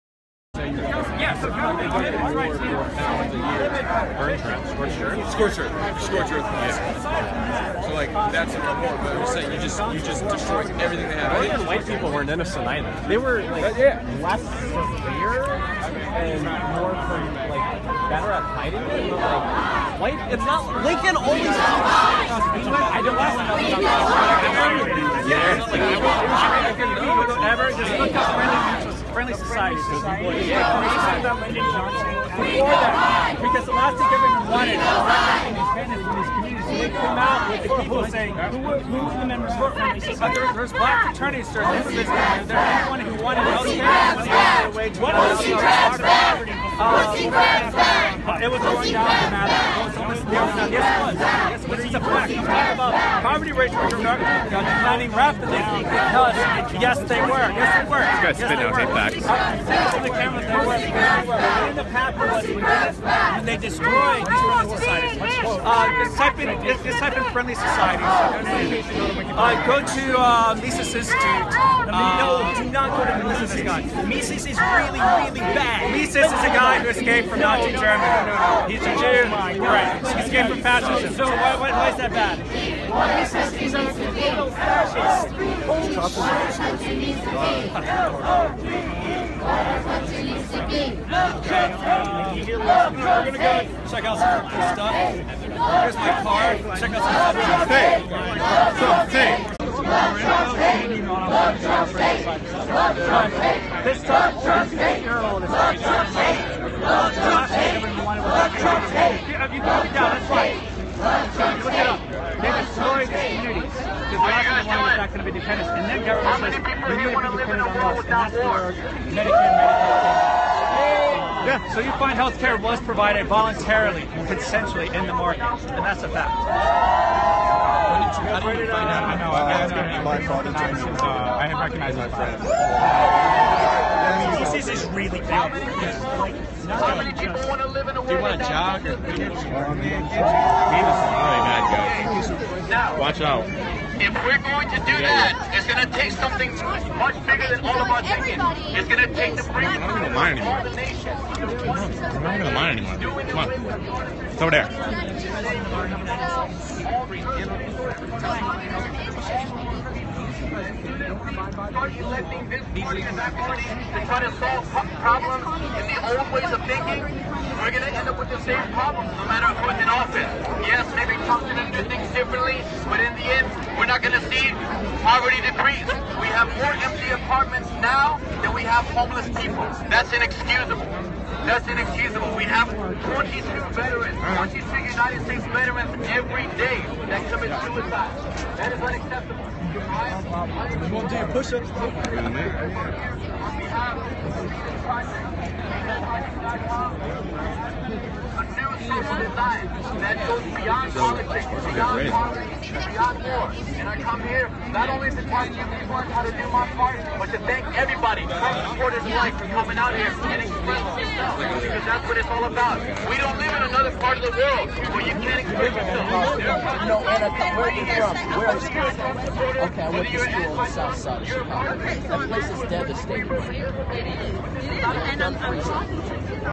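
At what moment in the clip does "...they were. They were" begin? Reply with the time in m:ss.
1:00.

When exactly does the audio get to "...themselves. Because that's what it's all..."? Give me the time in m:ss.
3:30.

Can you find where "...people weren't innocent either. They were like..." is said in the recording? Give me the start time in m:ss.
0:11.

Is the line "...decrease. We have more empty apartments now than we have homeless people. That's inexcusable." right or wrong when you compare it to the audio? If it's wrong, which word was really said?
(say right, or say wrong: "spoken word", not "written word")
right.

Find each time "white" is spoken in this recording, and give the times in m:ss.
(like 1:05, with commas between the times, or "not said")
0:11, 0:19.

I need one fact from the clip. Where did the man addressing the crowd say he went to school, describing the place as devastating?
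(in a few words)
south side of Chicago.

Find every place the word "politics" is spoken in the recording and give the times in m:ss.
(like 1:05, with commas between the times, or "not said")
3:20.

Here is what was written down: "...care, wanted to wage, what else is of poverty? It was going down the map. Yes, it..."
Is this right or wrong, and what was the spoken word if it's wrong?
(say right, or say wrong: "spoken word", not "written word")
right.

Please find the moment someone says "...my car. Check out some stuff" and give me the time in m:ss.
1:35.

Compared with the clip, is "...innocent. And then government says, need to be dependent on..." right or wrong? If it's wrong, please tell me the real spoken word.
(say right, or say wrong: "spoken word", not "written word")
wrong: "dependent", not "innocent".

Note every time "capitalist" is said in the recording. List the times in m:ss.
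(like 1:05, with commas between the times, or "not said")
1:01.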